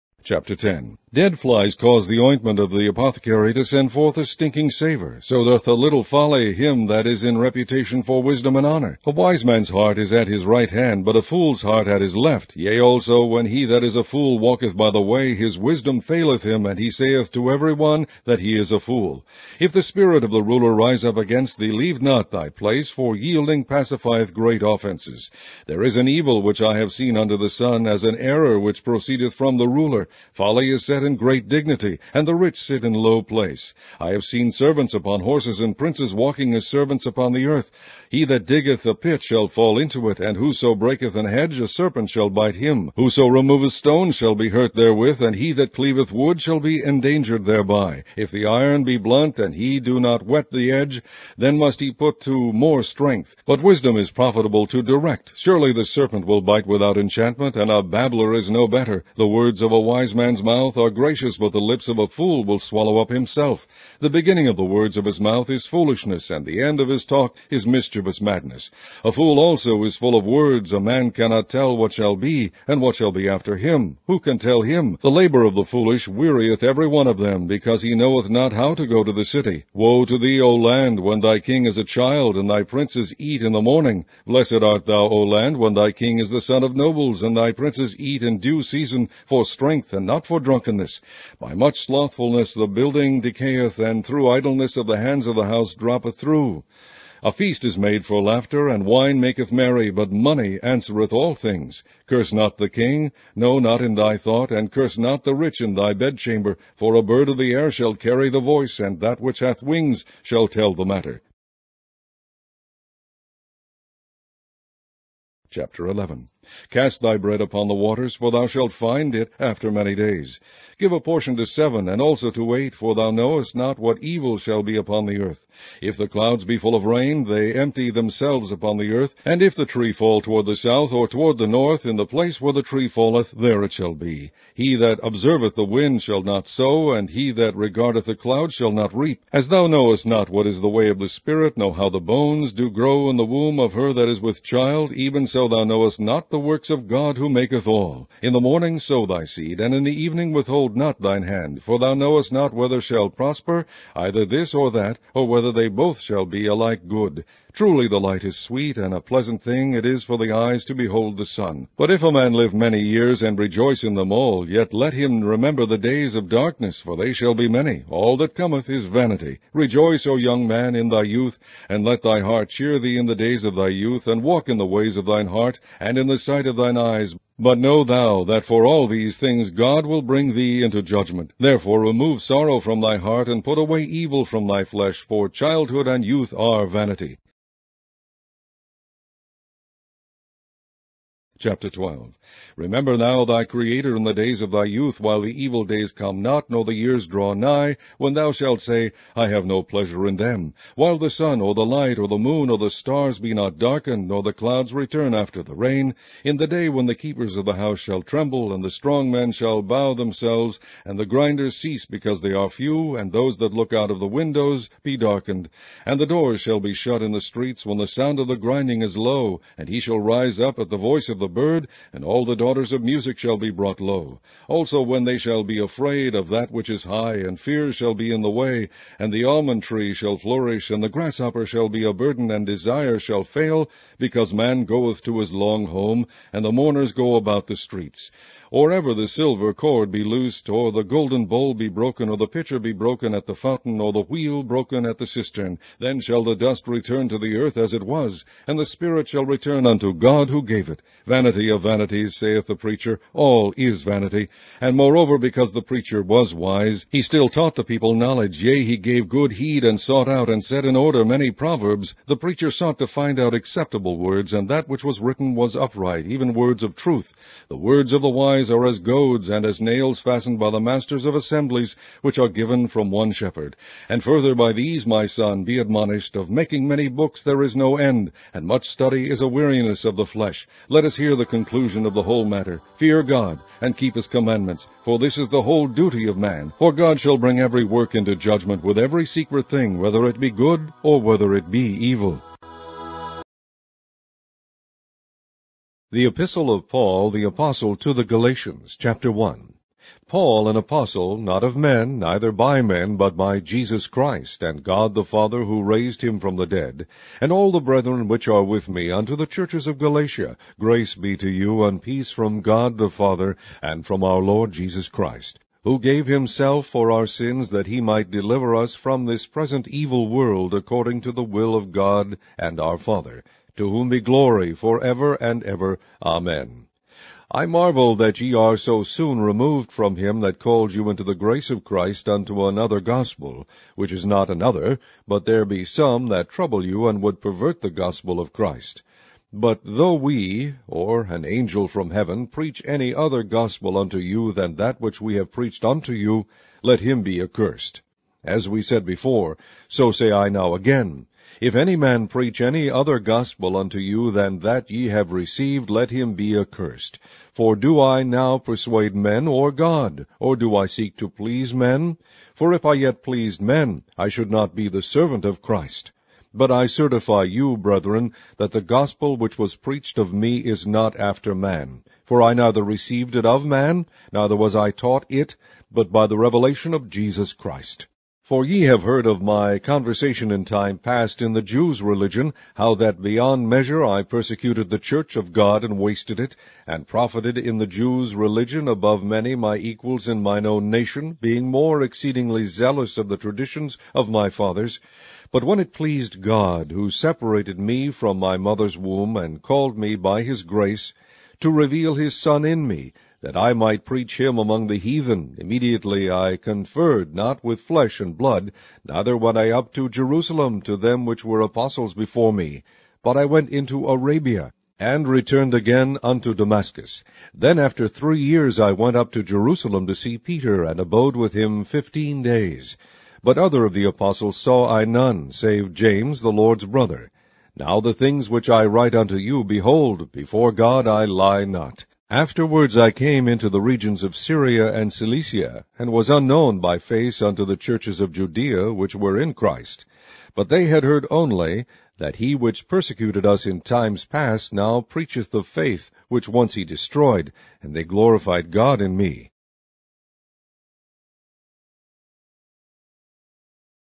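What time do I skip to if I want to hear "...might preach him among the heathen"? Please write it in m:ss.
6:43.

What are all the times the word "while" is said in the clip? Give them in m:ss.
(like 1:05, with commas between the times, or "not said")
3:14, 3:20.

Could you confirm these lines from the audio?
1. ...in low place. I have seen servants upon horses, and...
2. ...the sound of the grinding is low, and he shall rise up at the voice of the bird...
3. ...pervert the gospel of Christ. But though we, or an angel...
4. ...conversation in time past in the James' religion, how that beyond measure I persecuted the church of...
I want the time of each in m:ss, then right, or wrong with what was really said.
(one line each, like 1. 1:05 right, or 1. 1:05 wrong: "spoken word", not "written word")
1. 0:32 right
2. 3:37 right
3. 5:37 right
4. 6:19 wrong: "Jews", not "James".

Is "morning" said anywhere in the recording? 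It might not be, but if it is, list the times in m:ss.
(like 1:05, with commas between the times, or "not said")
1:23, 2:28.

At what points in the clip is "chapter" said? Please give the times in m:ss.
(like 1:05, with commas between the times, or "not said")
0:00, 1:55, 3:11, 4:58.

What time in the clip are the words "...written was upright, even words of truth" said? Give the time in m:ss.
4:24.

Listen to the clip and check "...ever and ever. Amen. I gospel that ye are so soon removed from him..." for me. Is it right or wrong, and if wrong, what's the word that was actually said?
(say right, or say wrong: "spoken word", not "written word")
wrong: "marvel", not "gospel".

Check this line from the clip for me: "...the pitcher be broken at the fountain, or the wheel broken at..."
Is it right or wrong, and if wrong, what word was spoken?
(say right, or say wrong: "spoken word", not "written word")
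right.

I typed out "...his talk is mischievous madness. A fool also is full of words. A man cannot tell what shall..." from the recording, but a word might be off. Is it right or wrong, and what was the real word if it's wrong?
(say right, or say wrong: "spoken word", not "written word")
right.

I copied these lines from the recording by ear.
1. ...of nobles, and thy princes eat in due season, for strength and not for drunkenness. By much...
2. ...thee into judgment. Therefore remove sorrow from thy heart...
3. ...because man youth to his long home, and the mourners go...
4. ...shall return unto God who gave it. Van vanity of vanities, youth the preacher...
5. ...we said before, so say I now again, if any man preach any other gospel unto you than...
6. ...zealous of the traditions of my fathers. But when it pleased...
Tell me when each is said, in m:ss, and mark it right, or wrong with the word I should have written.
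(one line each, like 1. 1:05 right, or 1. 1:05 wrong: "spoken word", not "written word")
1. 1:26 right
2. 3:00 right
3. 3:53 wrong: "goeth", not "youth"
4. 4:09 wrong: "saith", not "youth"
5. 5:48 right
6. 6:32 right.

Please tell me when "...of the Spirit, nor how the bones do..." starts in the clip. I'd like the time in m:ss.
2:20.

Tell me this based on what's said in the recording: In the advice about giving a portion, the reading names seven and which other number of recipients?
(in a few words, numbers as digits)
8.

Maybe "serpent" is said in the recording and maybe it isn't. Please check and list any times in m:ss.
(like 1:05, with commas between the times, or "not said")
0:41, 0:55.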